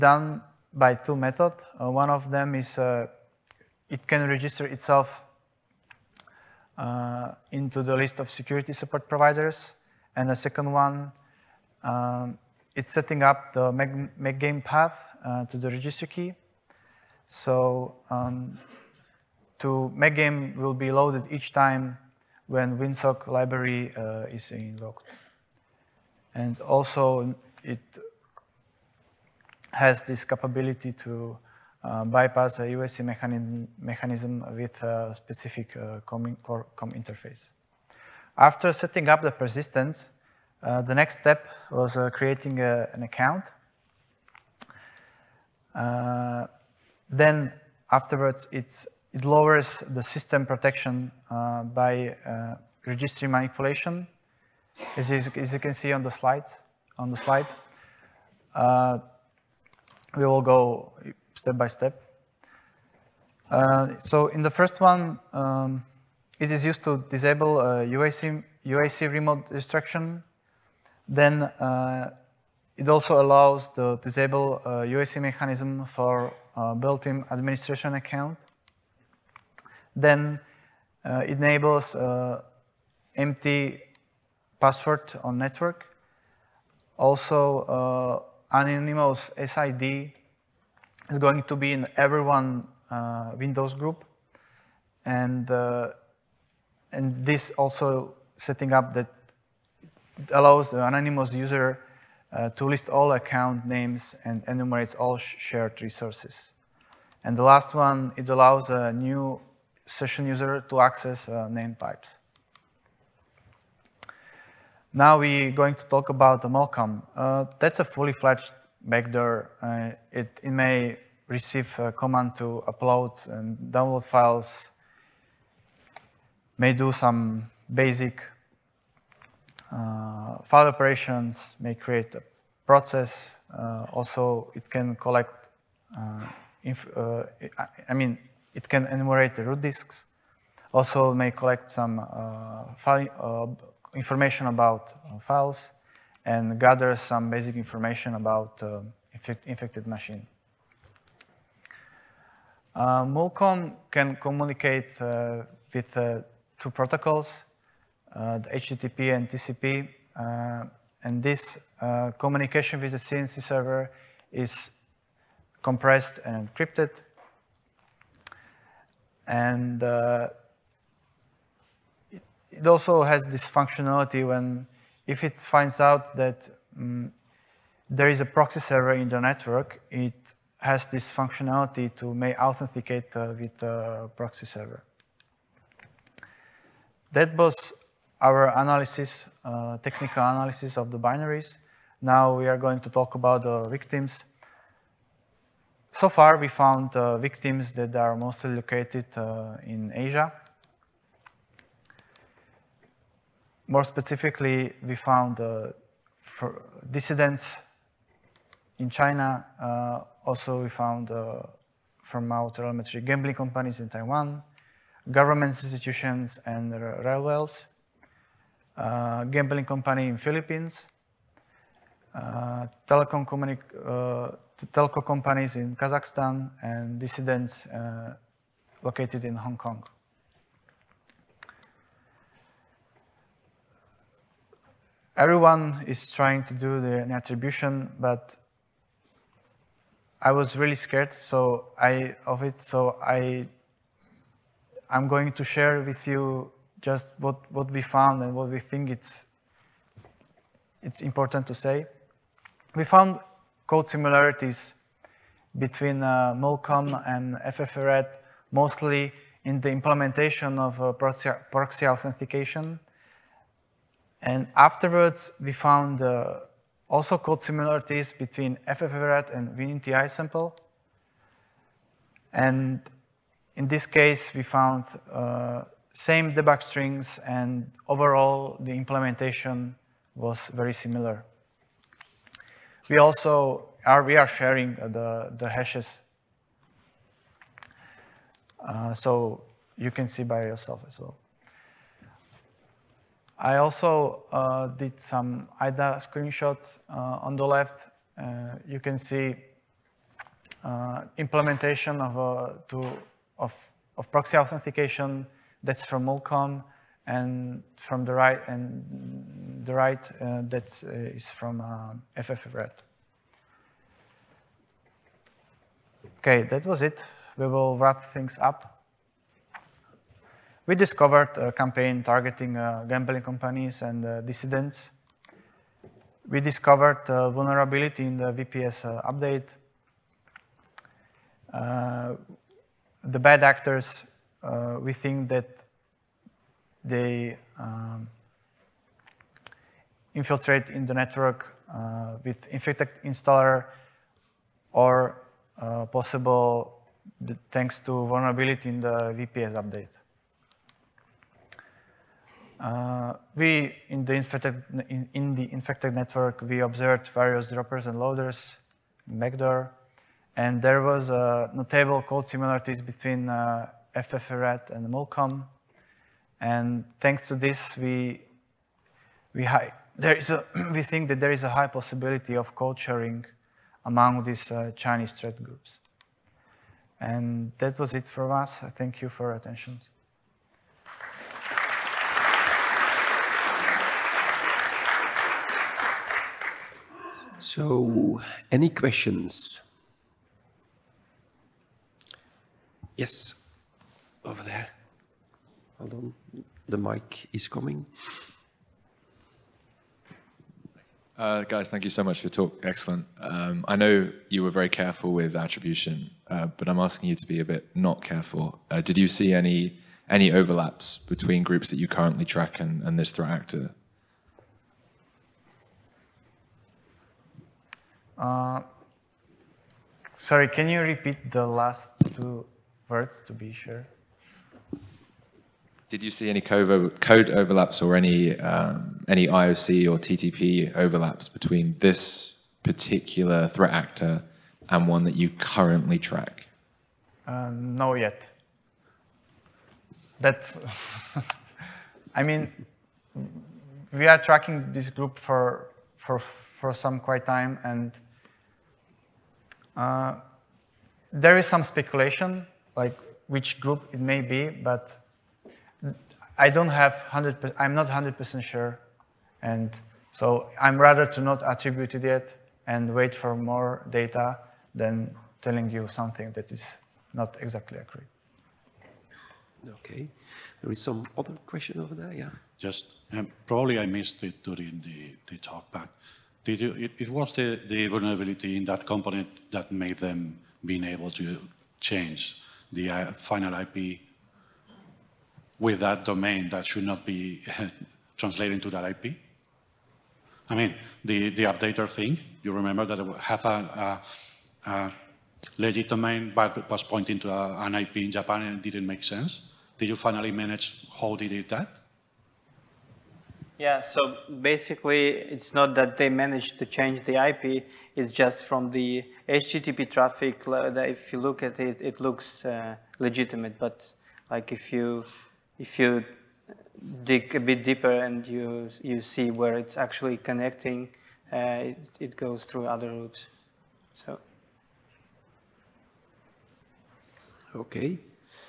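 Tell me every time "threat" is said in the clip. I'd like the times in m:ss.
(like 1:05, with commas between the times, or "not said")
6:15, 6:53, 7:13.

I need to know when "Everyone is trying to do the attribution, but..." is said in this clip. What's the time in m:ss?
3:55.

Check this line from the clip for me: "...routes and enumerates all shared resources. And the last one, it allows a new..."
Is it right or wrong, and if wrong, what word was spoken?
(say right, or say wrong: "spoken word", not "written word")
wrong: "names", not "routes".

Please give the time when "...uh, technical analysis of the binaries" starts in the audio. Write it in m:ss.
3:09.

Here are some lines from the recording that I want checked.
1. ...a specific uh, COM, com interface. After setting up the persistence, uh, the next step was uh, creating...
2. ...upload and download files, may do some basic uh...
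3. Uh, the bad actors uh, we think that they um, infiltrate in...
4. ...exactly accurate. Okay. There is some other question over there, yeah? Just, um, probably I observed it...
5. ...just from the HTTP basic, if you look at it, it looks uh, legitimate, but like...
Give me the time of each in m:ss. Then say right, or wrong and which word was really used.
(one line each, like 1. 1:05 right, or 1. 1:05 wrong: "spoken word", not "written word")
1. 0:34 right
2. 2:02 right
3. 5:31 right
4. 7:47 wrong: "missed", not "observed"
5. 8:28 wrong: "traffic", not "basic".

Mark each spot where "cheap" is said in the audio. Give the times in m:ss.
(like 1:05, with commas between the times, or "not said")
not said.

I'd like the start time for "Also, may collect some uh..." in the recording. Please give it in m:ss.
2:20.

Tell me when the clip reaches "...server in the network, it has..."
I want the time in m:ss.
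2:58.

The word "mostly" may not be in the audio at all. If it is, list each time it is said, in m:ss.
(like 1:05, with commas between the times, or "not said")
3:18, 4:18.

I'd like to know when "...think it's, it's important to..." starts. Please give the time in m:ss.
4:08.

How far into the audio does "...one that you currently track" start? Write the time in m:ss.
7:14.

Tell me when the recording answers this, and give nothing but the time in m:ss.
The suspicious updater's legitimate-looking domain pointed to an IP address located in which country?
8:18.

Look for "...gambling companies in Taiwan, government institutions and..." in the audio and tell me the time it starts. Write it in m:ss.
3:33.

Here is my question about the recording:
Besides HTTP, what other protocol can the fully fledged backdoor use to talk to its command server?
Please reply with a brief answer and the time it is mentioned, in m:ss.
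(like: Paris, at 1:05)
TCP, at 2:39.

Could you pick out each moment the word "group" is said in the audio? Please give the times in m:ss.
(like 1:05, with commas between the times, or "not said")
1:33, 6:15, 6:51, 7:24, 7:33.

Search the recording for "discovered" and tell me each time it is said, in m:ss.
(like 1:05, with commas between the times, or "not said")
5:20, 5:26.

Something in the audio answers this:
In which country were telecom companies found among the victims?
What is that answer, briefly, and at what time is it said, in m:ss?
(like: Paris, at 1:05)
Kazakhstan, at 3:45.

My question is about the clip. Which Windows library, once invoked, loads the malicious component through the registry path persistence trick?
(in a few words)
WinSock.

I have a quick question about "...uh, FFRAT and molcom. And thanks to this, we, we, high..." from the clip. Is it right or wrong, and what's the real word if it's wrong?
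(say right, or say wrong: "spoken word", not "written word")
right.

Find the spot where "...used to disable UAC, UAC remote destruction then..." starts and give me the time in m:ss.
1:06.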